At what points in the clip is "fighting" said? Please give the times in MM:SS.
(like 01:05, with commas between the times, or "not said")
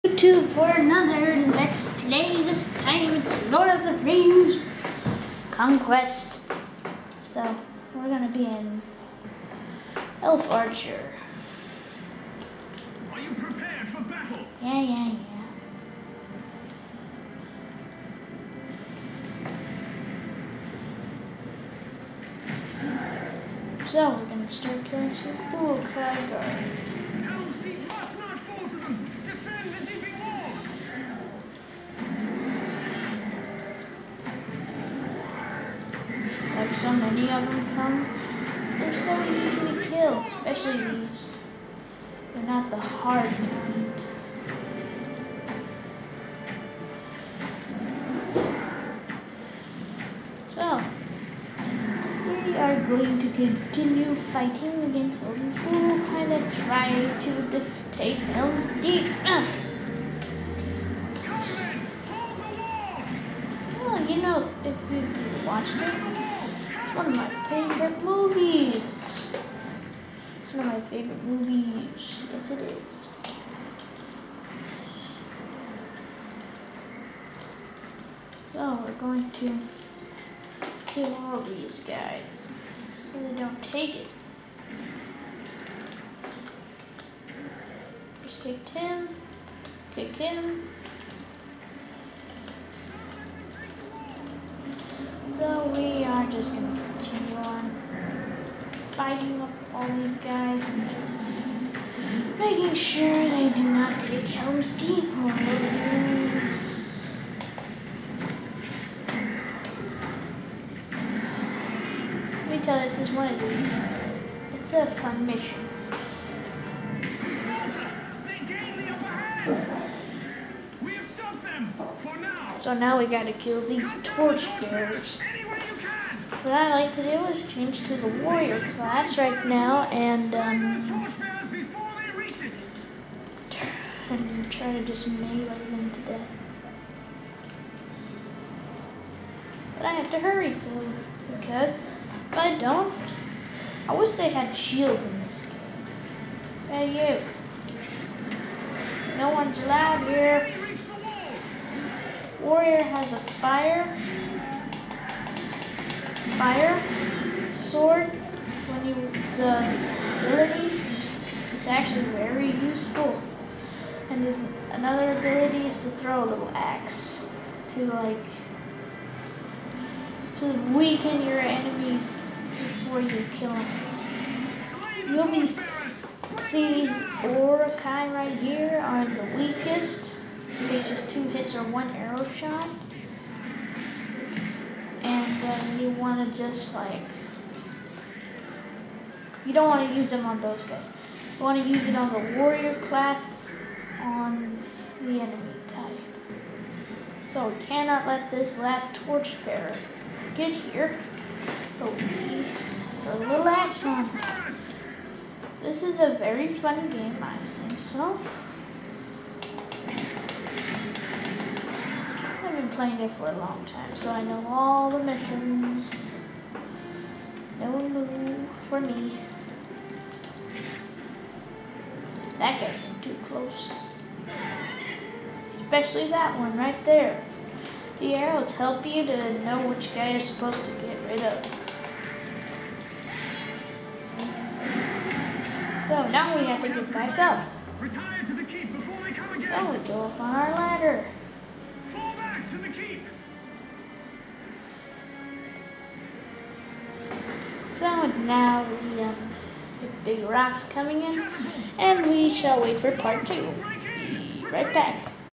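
00:54, 01:38.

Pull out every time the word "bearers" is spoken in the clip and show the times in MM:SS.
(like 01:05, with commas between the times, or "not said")
02:04, 03:19.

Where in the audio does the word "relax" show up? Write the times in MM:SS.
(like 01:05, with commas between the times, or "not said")
03:23.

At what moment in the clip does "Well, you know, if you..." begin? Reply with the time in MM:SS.
01:03.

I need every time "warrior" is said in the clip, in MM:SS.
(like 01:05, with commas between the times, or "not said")
02:08, 02:32, 03:12.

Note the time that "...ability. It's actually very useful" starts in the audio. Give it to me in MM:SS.
02:40.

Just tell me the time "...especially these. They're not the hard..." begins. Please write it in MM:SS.
00:40.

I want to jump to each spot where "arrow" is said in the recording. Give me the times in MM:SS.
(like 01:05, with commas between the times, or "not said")
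03:01, 03:48.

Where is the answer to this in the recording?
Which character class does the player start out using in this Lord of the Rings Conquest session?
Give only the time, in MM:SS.
00:10.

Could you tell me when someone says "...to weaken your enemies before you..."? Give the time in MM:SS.
02:50.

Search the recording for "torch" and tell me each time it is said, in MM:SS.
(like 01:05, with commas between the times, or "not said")
02:04, 03:18.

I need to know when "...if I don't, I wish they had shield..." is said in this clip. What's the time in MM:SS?
02:22.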